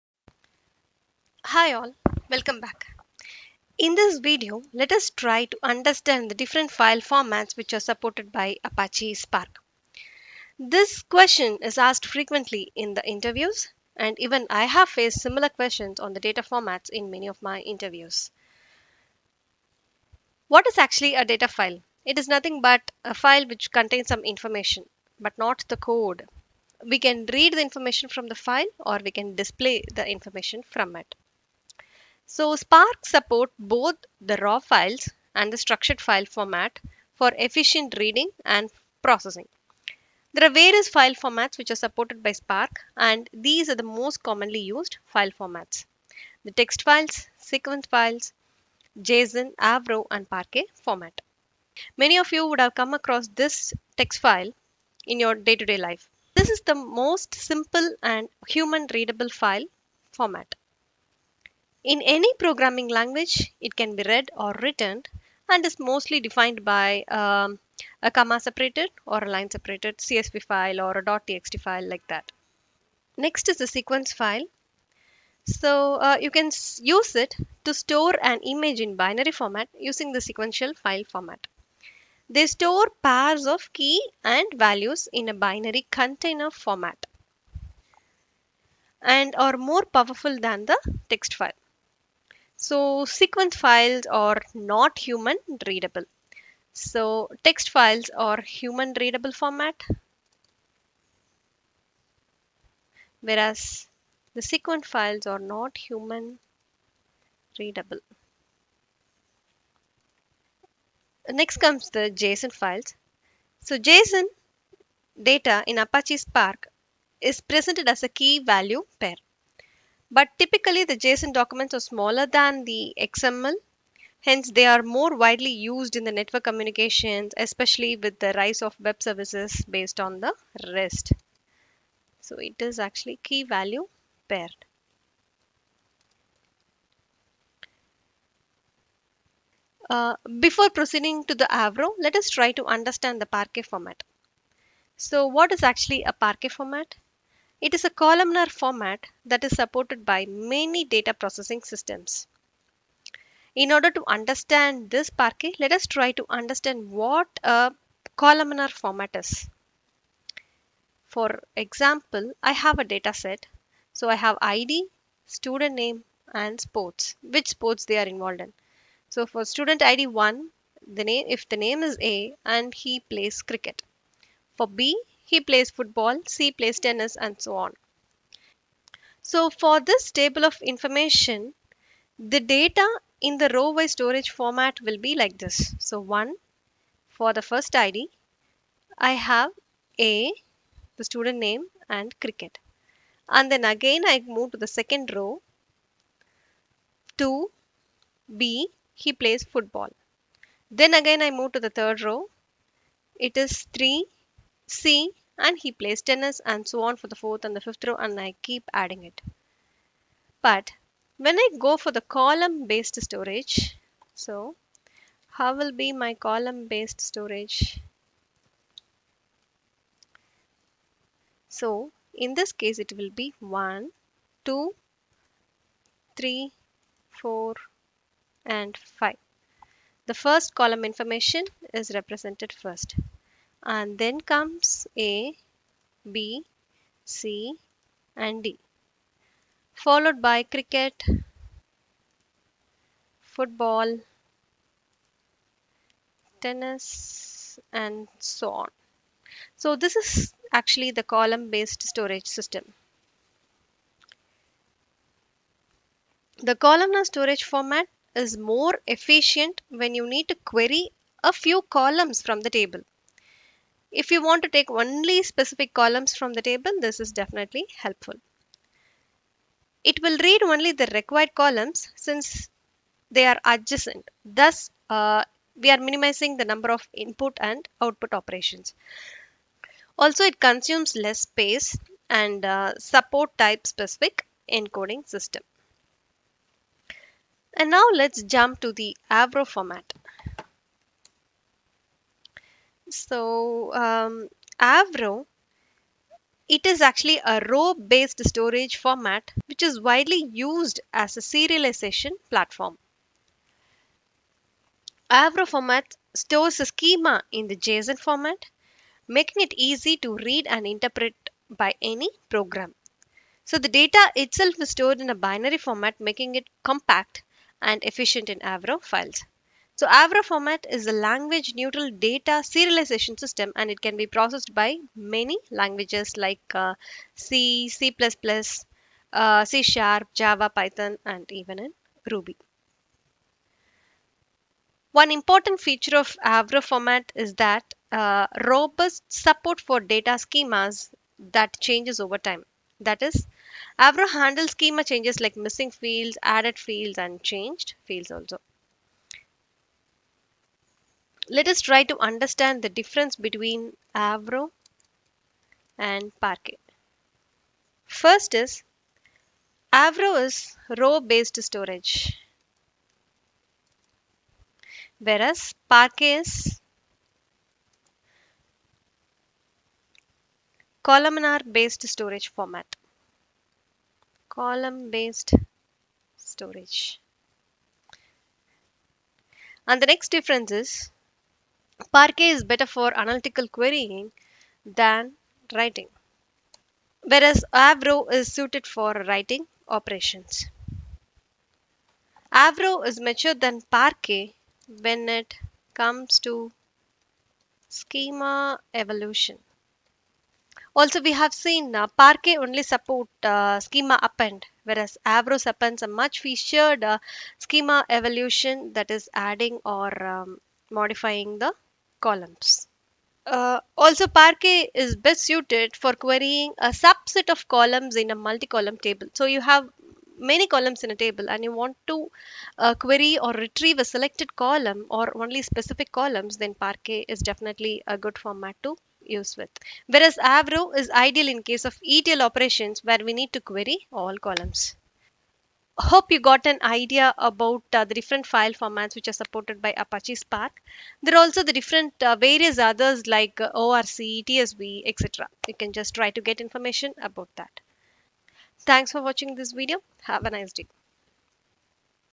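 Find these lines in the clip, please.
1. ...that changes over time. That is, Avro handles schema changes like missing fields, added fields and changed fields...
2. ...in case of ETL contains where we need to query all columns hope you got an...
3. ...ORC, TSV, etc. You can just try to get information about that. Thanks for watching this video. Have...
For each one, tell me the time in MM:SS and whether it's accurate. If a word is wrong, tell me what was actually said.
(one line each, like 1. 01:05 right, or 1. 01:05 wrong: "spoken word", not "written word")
1. 05:41 right
2. 07:11 wrong: "operations", not "contains"
3. 07:23 right.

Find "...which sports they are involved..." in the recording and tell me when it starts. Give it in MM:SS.
02:47.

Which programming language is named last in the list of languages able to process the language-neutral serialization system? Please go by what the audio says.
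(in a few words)
Ruby.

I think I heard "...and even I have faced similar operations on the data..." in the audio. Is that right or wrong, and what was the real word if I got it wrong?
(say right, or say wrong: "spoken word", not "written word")
wrong: "questions", not "operations".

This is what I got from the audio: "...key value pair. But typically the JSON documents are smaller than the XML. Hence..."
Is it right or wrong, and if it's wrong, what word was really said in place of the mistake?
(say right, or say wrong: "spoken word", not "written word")
right.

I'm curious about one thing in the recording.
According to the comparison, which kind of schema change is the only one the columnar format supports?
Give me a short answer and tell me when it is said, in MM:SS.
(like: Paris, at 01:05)
Schema append, at 06:43.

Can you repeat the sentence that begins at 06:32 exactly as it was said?
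Avro is mature than Parquet when it comes to schema evolution.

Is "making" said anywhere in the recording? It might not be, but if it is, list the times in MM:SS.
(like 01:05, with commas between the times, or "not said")
05:09, 05:16.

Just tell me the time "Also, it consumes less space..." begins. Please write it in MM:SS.
04:39.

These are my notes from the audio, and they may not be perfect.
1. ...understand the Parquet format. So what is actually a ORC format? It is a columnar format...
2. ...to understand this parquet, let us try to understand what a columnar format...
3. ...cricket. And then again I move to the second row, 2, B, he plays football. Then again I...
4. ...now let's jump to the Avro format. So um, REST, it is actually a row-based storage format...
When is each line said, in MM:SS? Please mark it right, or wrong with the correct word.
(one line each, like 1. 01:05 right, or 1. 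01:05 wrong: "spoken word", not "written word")
1. 02:22 wrong: "Parquet", not "ORC"
2. 02:33 right
3. 03:12 right
4. 04:47 wrong: "Avro", not "REST".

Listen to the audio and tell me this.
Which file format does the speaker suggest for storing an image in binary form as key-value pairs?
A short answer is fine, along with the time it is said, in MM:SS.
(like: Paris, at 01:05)
Sequence file, at 01:13.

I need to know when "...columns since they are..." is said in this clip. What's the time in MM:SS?
04:31.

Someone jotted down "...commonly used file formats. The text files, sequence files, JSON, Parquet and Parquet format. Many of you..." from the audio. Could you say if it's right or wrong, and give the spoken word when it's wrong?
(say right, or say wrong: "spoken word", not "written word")
wrong: "Avro", not "Parquet".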